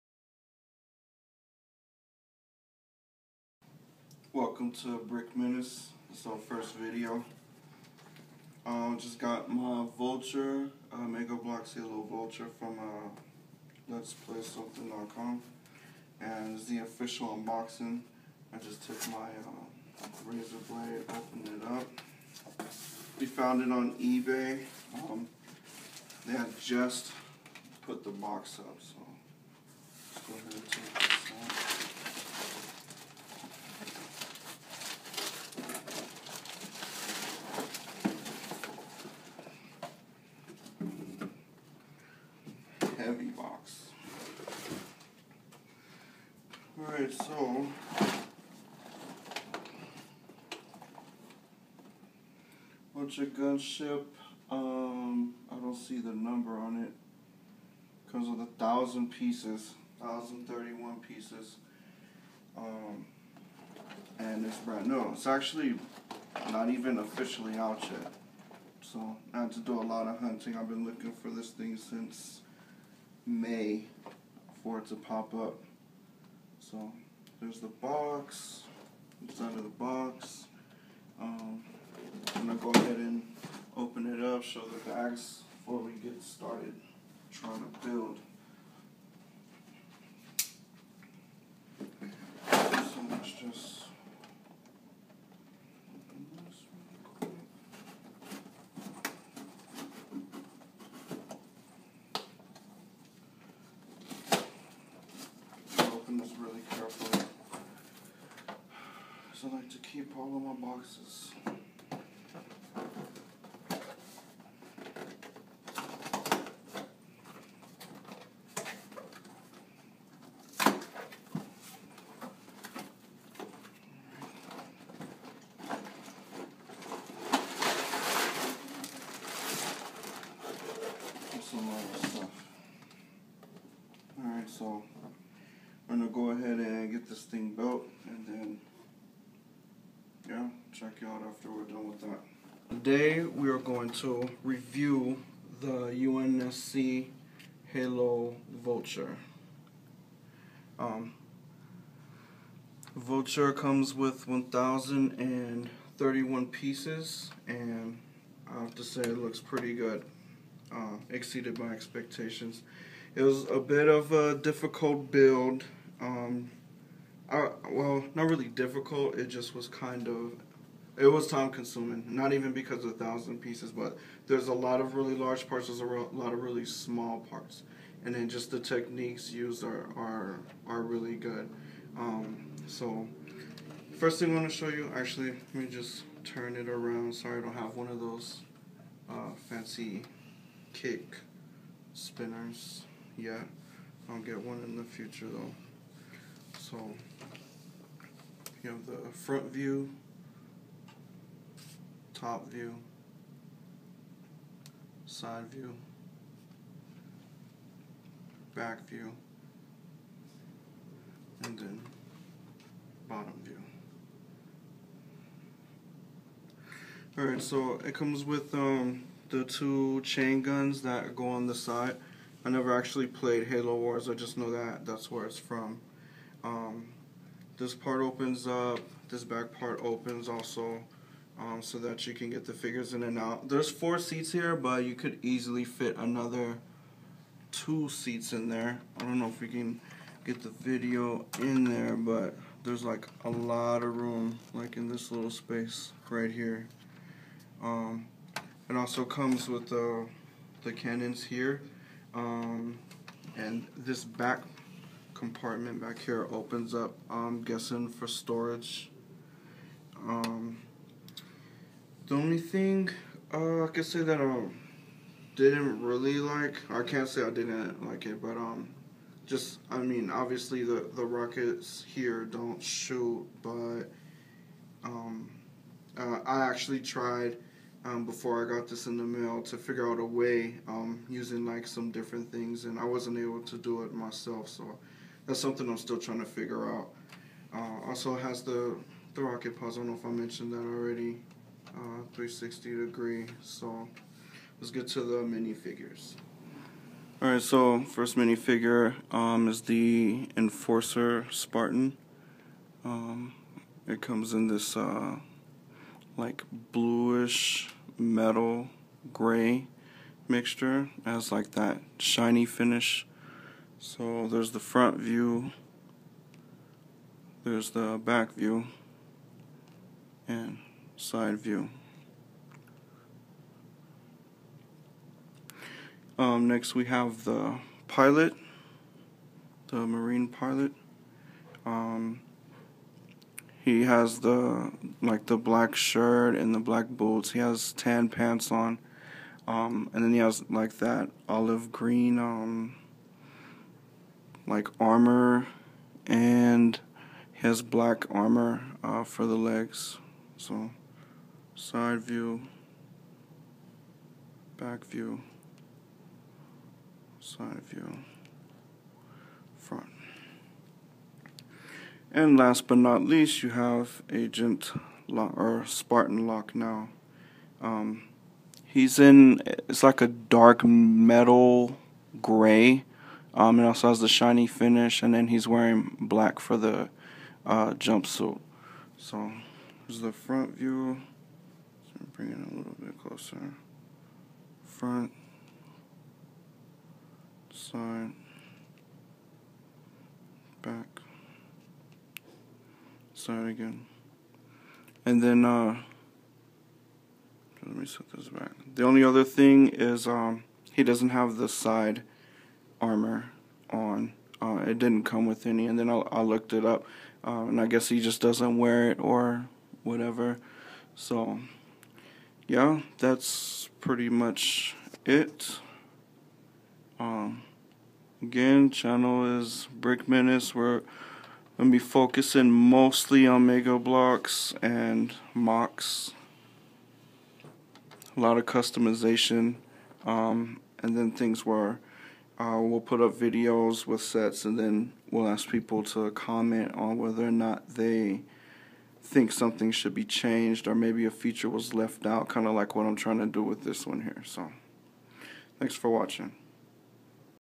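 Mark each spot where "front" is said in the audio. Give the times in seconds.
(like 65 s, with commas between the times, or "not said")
199 s, 314 s, 359 s, 380 s, 384 s.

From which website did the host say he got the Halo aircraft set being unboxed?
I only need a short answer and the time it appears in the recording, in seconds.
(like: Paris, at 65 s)
Let's Play Something.com, at 13 s.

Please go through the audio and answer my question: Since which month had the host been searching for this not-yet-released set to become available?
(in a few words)
May.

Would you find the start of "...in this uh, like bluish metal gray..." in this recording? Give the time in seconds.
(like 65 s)
304 s.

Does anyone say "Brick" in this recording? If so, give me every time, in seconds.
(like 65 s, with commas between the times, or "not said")
4 s, 419 s.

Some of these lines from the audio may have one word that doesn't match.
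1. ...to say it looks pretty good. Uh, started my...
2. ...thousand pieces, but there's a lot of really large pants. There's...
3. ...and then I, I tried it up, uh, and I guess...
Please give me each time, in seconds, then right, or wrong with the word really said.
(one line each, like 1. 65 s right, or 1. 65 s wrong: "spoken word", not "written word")
1. 158 s wrong: "exceeded", not "started"
2. 172 s wrong: "parts", not "pants"
3. 405 s wrong: "looked", not "tried".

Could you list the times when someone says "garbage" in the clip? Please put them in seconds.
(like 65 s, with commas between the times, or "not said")
not said.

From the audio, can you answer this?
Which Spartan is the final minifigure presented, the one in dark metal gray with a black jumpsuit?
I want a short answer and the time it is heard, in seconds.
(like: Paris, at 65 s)
Locke, at 366 s.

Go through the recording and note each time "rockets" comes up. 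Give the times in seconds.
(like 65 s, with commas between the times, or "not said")
271 s, 289 s.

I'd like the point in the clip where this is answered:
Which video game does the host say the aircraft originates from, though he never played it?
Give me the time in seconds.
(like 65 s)
223 s.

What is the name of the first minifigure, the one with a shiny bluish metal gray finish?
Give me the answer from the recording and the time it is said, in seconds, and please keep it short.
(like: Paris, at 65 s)
Enforcer Spartan, at 300 s.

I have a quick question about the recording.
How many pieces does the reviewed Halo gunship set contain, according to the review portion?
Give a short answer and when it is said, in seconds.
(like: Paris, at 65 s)
1031, at 154 s.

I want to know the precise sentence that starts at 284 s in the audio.
So that's something I'm still trying to figure out.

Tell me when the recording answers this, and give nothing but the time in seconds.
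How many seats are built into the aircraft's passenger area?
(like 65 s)
233 s.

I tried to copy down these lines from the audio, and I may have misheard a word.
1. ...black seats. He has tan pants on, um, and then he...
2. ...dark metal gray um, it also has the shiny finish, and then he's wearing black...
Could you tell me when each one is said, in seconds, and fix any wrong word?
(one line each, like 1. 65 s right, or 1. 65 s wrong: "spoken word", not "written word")
1. 336 s wrong: "boots", not "seats"
2. 370 s right.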